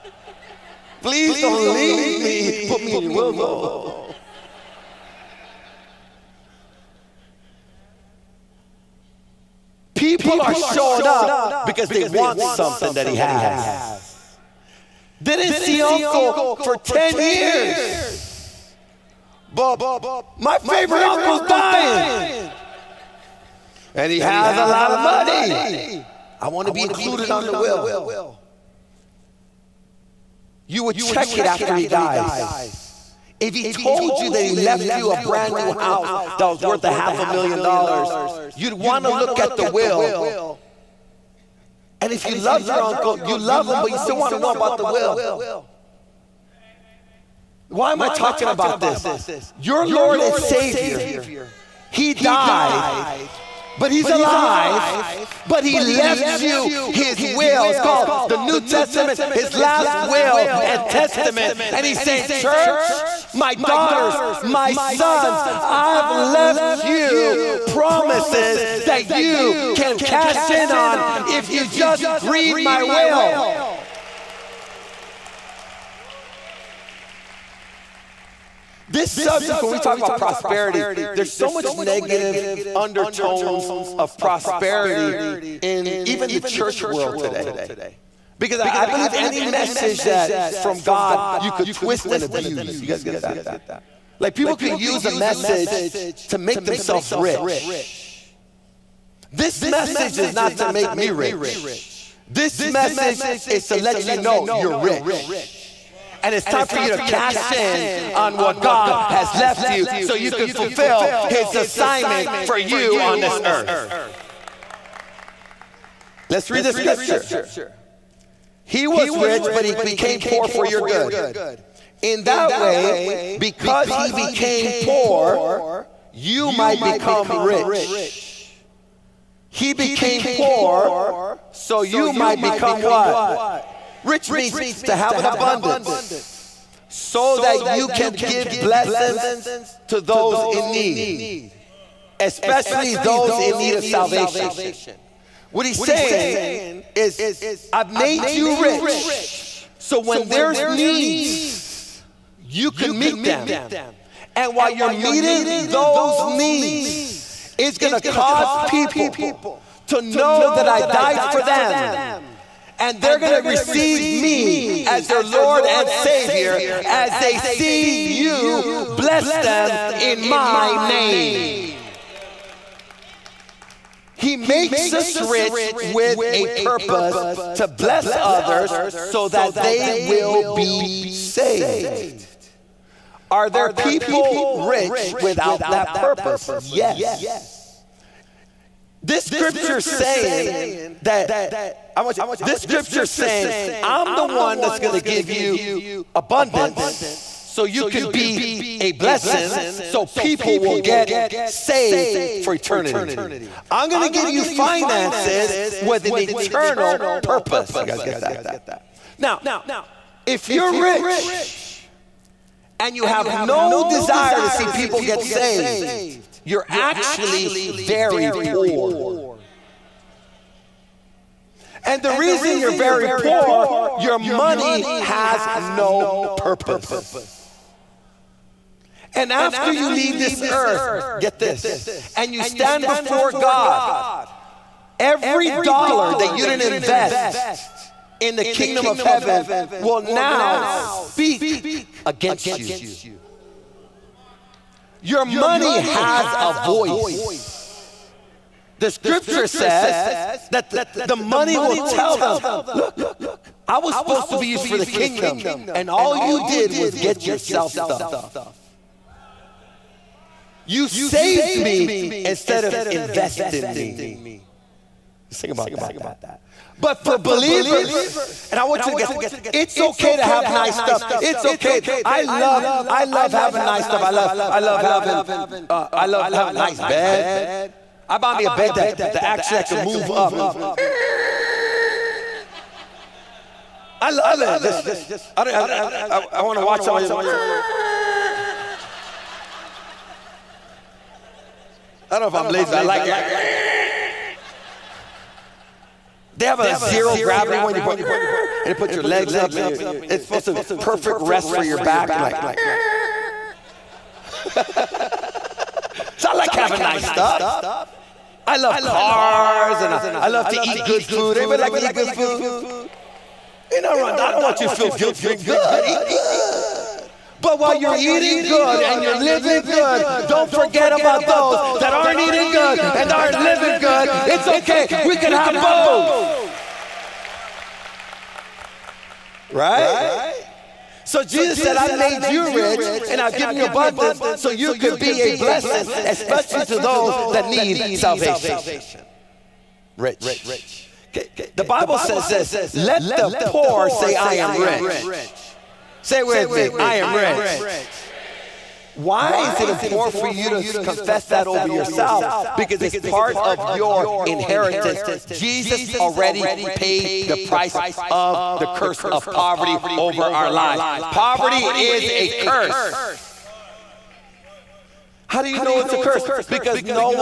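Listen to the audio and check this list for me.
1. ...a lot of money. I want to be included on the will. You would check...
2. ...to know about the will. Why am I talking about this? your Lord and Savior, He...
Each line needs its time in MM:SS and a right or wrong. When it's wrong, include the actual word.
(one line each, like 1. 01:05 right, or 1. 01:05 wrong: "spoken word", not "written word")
1. 00:24 right
2. 00:44 right.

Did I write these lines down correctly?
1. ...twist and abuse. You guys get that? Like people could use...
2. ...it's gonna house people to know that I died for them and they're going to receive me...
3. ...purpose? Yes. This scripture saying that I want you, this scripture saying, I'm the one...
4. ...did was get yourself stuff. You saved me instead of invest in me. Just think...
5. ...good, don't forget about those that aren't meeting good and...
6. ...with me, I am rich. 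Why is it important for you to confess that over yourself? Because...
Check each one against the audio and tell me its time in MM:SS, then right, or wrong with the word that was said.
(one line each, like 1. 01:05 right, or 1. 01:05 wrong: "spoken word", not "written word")
1. 01:31 right
2. 02:37 wrong: "cause", not "house"
3. 03:05 right
4. 04:16 right
5. 05:19 wrong: "eating", not "meeting"
6. 05:46 right.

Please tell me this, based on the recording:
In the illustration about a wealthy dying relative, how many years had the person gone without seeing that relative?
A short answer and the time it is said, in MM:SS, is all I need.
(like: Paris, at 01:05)
10, at 00:16.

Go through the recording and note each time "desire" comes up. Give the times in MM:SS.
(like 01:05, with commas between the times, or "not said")
03:33.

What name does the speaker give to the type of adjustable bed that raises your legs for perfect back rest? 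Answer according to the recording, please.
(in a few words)
zero gravity.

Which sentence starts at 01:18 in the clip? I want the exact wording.
This subject, when we talk about prosperity, there's so much negative undertones of prosperity in even the church world today.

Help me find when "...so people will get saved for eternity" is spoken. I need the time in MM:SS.
03:19.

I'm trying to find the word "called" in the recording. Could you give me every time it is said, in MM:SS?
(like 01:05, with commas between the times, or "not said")
00:57.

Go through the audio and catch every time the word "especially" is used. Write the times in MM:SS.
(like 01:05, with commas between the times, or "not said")
02:22, 05:36.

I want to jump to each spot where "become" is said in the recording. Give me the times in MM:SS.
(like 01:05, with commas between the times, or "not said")
02:06, 02:12.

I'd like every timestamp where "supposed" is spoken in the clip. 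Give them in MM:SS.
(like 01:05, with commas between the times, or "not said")
04:13, 05:00.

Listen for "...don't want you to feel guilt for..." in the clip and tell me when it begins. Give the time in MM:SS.
05:14.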